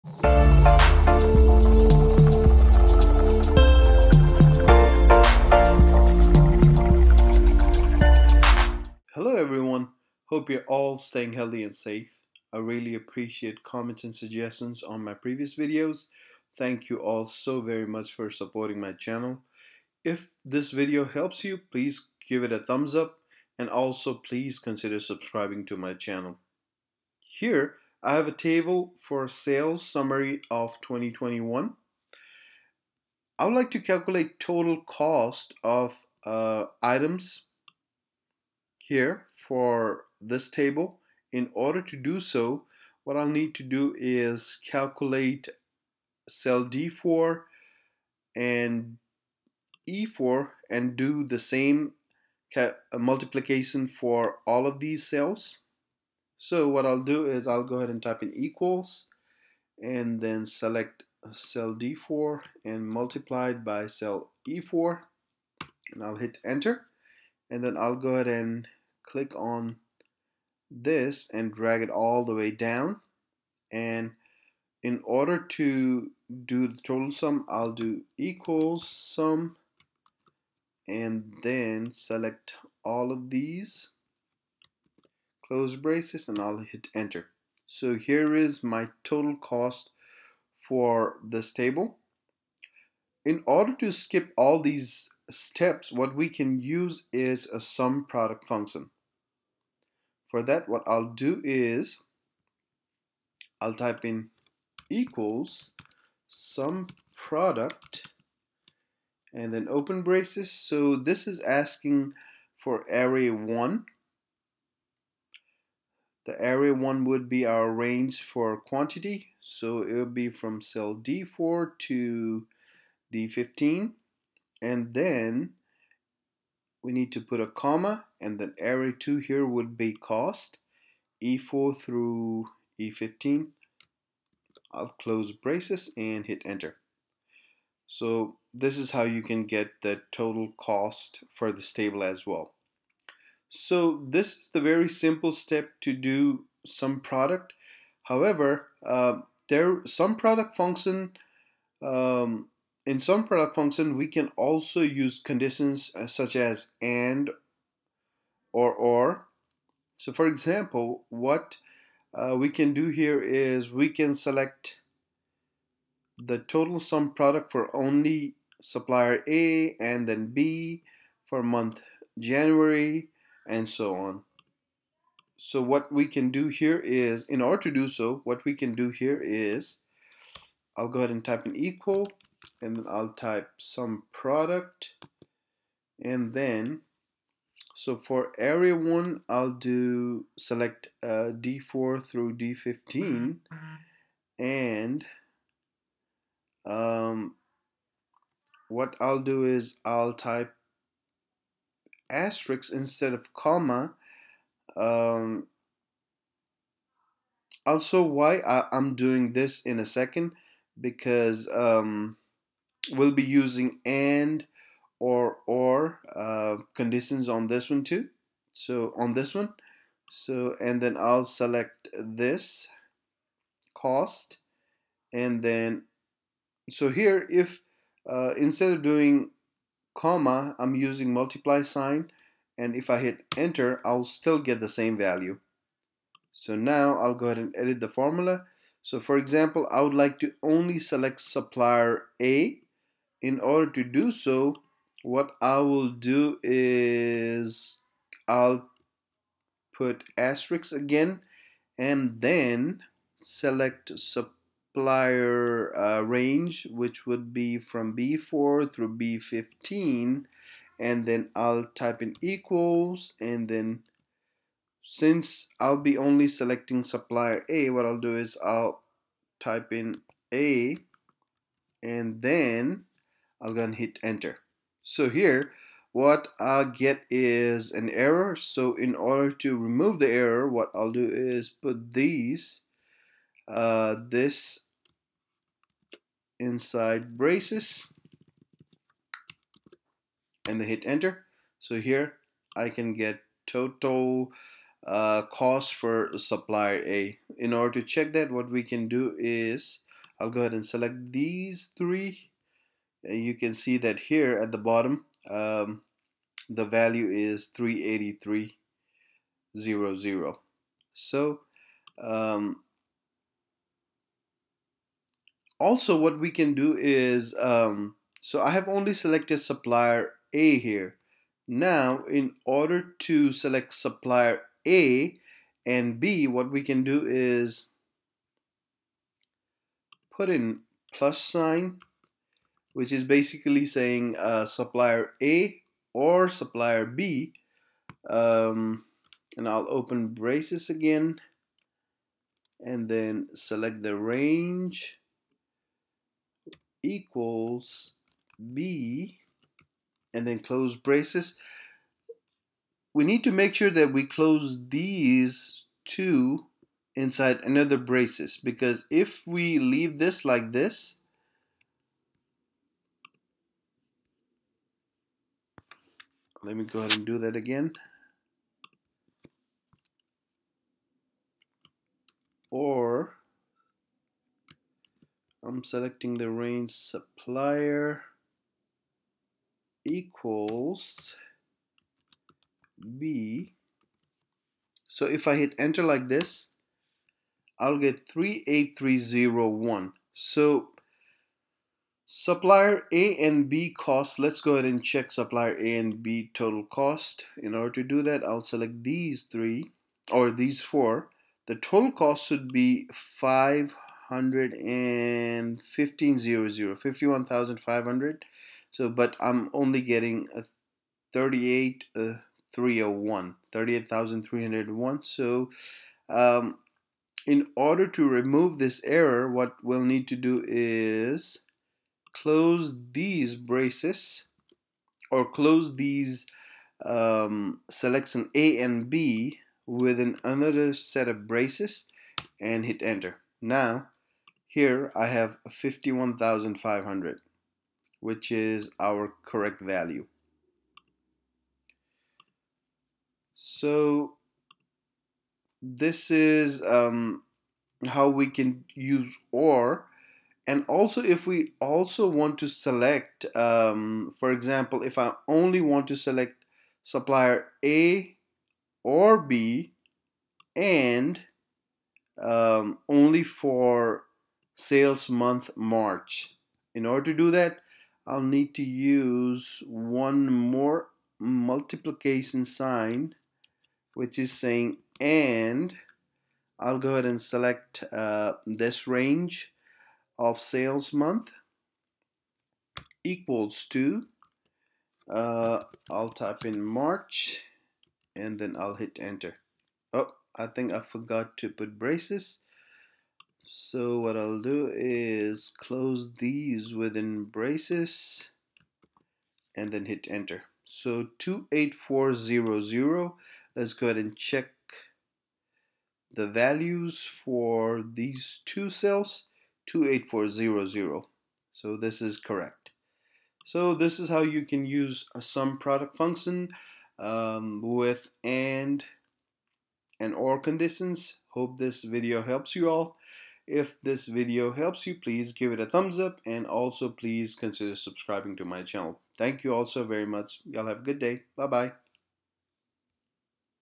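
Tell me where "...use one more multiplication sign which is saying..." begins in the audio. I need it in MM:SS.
07:48.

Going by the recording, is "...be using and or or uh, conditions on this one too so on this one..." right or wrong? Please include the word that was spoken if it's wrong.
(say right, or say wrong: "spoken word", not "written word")
right.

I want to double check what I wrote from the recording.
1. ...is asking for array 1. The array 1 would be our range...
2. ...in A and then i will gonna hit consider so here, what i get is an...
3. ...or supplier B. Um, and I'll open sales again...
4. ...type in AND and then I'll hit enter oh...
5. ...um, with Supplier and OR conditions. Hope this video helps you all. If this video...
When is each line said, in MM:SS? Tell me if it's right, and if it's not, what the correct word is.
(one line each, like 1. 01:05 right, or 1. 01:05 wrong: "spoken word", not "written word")
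1. 01:51 right
2. 04:29 wrong: "enter", not "consider"
3. 05:35 wrong: "braces", not "sales"
4. 08:06 wrong: "March", not "AND"
5. 08:36 wrong: "AND", not "Supplier".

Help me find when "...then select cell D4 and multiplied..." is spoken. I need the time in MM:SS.
01:00.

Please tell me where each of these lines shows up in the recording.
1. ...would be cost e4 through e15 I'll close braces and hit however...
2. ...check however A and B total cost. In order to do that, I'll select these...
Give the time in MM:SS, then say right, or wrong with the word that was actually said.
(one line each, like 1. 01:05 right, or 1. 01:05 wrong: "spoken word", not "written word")
1. 02:09 wrong: "enter", not "however"
2. 06:34 wrong: "supplier", not "however".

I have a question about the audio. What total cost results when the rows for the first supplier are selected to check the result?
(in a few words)
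38,300.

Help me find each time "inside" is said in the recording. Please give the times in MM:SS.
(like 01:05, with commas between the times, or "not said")
04:46, 05:56.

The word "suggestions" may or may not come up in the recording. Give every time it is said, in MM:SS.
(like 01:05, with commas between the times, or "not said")
00:14.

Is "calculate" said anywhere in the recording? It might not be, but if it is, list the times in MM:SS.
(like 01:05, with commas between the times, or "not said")
00:33, 00:44.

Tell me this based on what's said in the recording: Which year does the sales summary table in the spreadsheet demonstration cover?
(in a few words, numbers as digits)
2021.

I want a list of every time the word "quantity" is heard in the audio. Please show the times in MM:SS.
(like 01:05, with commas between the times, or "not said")
01:58.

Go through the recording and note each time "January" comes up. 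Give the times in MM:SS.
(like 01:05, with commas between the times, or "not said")
02:52.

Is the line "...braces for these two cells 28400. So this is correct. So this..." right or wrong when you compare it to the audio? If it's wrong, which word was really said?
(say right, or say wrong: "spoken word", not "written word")
wrong: "values", not "braces".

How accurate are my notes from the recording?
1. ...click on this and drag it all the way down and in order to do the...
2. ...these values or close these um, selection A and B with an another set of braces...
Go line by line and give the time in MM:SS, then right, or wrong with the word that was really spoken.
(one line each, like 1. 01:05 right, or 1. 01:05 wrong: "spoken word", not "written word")
1. 01:09 right
2. 07:02 wrong: "braces", not "values".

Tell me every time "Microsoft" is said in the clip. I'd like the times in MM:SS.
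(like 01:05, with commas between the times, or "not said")
not said.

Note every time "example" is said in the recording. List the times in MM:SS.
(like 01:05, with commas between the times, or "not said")
02:40, 03:59, 07:34.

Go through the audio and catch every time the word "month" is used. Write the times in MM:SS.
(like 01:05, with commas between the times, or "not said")
02:51, 07:45, 08:00.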